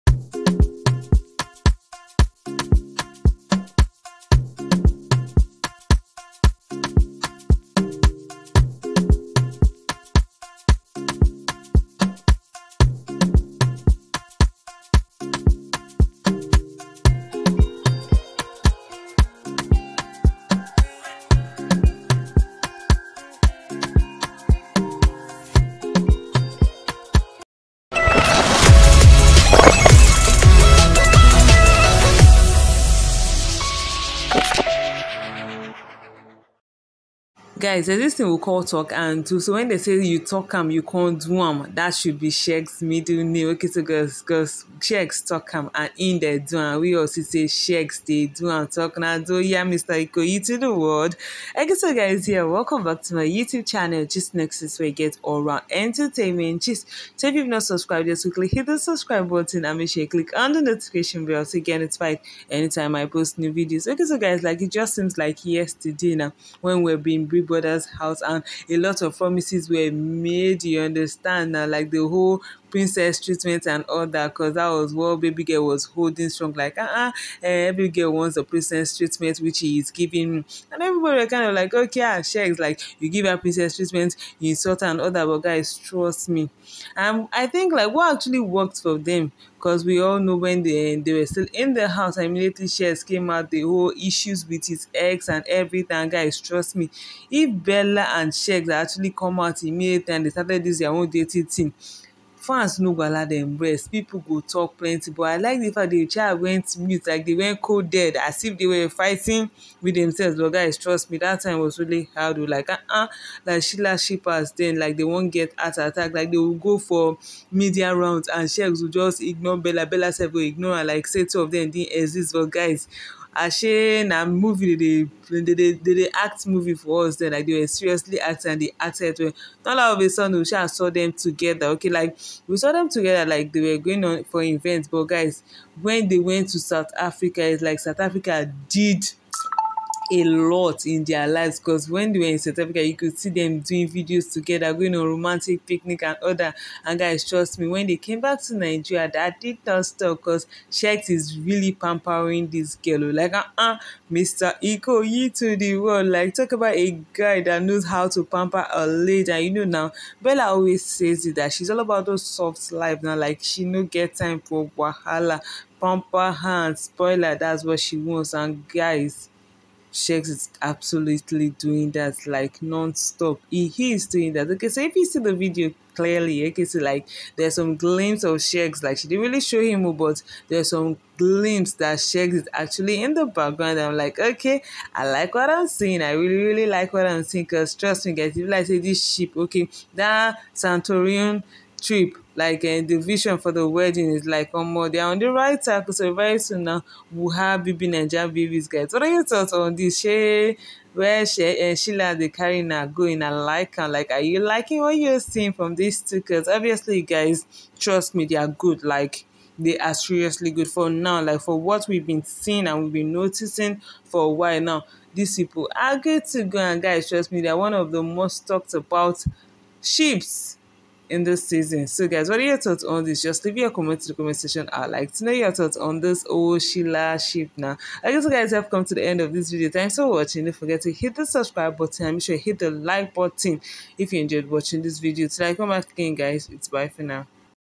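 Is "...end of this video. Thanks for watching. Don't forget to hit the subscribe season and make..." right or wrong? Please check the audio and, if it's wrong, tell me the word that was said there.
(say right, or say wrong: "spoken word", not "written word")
wrong: "button", not "season".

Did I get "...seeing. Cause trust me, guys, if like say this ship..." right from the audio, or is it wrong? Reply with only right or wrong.
right.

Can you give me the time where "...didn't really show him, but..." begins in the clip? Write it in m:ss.
2:59.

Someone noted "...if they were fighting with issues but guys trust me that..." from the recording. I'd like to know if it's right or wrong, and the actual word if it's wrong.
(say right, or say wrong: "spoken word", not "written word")
wrong: "themselves", not "issues".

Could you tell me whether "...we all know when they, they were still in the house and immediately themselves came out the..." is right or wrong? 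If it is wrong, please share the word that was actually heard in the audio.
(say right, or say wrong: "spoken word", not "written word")
wrong: "shares", not "themselves".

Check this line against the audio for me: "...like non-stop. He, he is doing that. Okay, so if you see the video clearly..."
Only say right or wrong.
right.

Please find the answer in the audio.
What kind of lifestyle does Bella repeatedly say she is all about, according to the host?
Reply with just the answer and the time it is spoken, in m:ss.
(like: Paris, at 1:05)
soft life, at 2:42.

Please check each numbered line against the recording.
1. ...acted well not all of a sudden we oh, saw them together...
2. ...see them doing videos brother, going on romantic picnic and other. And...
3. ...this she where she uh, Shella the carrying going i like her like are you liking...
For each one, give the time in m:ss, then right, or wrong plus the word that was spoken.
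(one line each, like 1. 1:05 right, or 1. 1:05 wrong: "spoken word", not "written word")
1. 2:08 right
2. 2:23 wrong: "together", not "brother"
3. 3:19 right.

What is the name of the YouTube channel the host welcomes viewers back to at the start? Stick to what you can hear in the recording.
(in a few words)
Gist Nexus.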